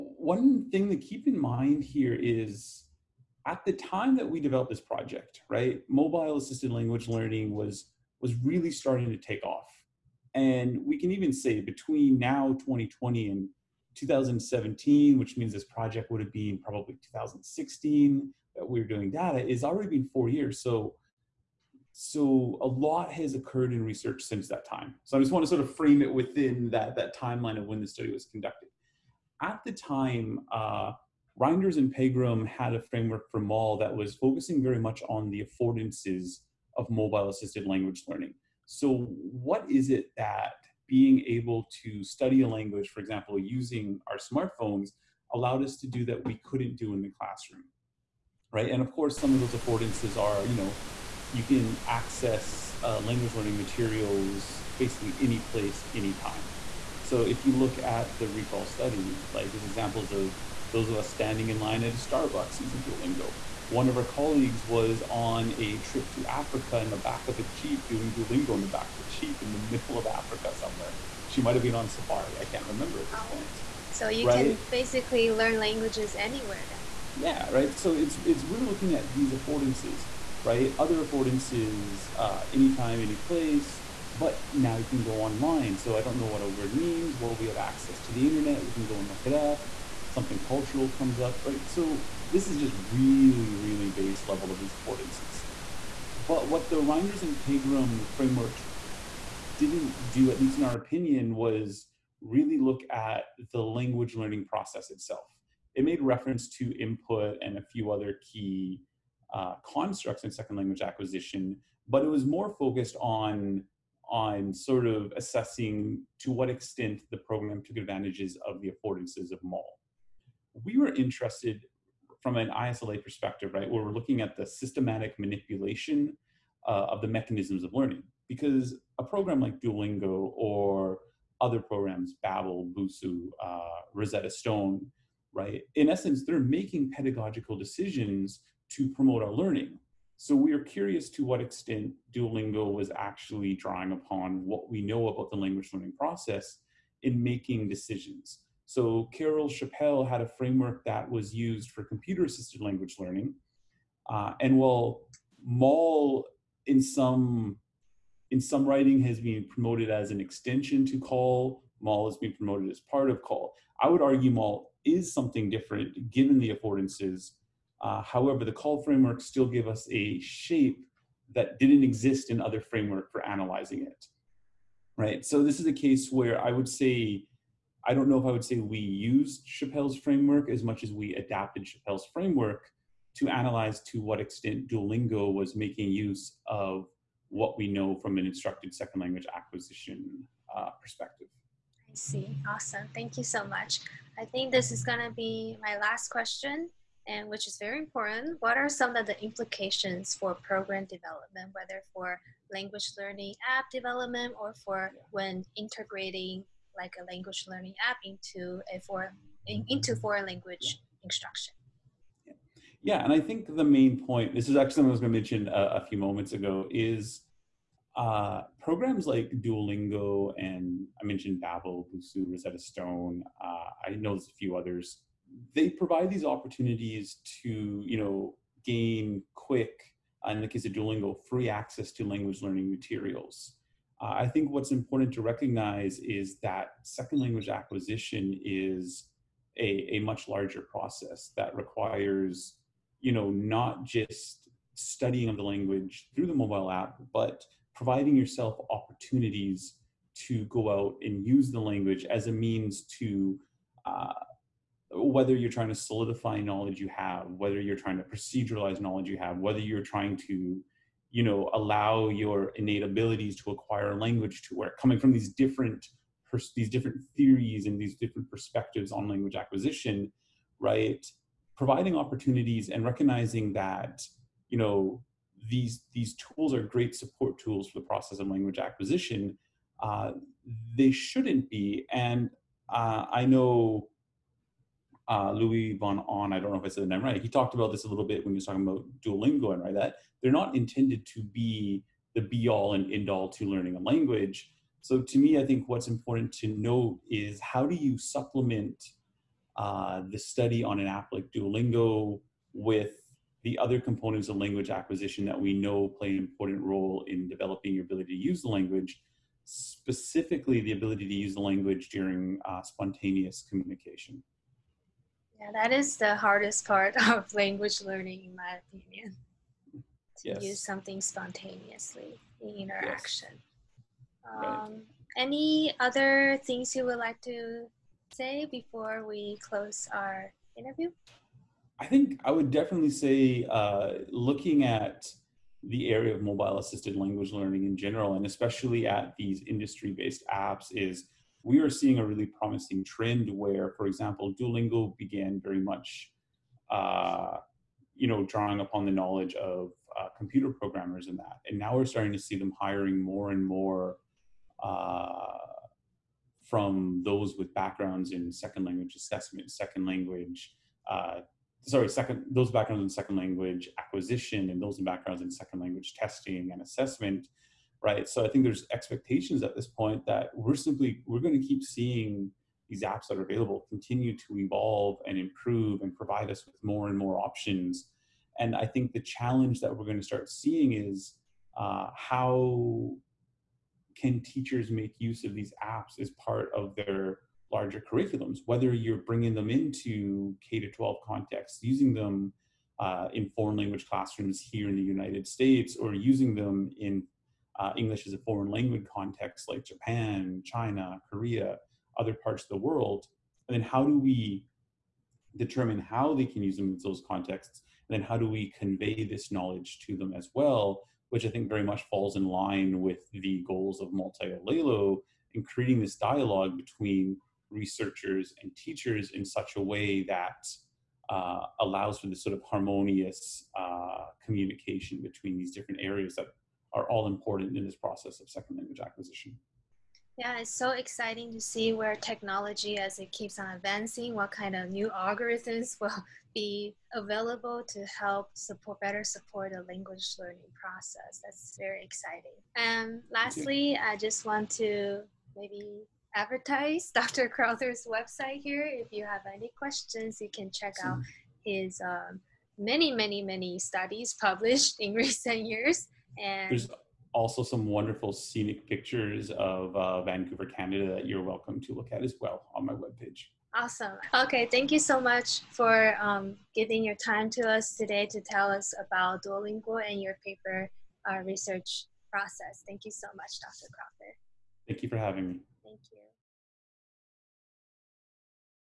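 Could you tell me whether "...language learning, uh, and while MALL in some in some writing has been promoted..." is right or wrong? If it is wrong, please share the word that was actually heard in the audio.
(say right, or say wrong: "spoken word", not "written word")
right.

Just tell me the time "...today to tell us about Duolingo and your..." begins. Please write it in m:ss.
7:47.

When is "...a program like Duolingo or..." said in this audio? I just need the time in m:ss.
2:08.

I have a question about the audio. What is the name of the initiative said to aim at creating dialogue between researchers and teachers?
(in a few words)
Multi Olelo.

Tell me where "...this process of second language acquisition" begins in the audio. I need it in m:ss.
7:07.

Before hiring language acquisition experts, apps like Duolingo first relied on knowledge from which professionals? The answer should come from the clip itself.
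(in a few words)
computer programmers.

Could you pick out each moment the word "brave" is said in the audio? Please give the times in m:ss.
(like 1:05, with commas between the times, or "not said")
not said.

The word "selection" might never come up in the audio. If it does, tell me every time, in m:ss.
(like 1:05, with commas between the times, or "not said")
not said.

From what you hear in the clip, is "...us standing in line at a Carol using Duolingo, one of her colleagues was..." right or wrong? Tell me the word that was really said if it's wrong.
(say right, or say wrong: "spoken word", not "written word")
wrong: "Starbucks", not "Carol".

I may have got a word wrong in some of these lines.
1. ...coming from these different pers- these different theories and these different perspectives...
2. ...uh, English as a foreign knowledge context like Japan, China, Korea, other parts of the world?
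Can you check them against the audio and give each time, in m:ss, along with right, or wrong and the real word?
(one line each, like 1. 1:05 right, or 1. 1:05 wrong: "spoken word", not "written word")
1. 4:24 right
2. 6:37 wrong: "language", not "knowledge".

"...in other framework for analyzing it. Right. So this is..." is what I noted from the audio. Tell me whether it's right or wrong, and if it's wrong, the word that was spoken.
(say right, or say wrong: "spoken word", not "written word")
right.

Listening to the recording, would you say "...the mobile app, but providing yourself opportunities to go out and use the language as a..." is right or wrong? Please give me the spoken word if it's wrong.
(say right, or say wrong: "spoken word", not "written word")
right.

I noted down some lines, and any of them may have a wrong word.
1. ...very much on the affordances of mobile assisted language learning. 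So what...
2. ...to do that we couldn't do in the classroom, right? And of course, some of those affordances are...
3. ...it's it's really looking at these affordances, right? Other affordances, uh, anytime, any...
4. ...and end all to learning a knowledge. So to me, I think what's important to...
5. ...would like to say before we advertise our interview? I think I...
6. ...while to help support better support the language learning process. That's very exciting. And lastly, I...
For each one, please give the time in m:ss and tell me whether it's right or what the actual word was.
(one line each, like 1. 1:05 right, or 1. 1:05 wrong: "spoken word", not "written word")
1. 0:34 right
2. 0:45 right
3. 1:17 right
4. 4:52 wrong: "language", not "knowledge"
5. 5:26 wrong: "close", not "advertise"
6. 7:16 wrong: "available", not "while".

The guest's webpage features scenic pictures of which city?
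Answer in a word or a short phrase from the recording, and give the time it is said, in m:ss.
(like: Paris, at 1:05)
Vancouver, at 7:40.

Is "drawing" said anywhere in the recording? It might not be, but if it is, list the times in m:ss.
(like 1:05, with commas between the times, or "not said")
2:23, 5:48.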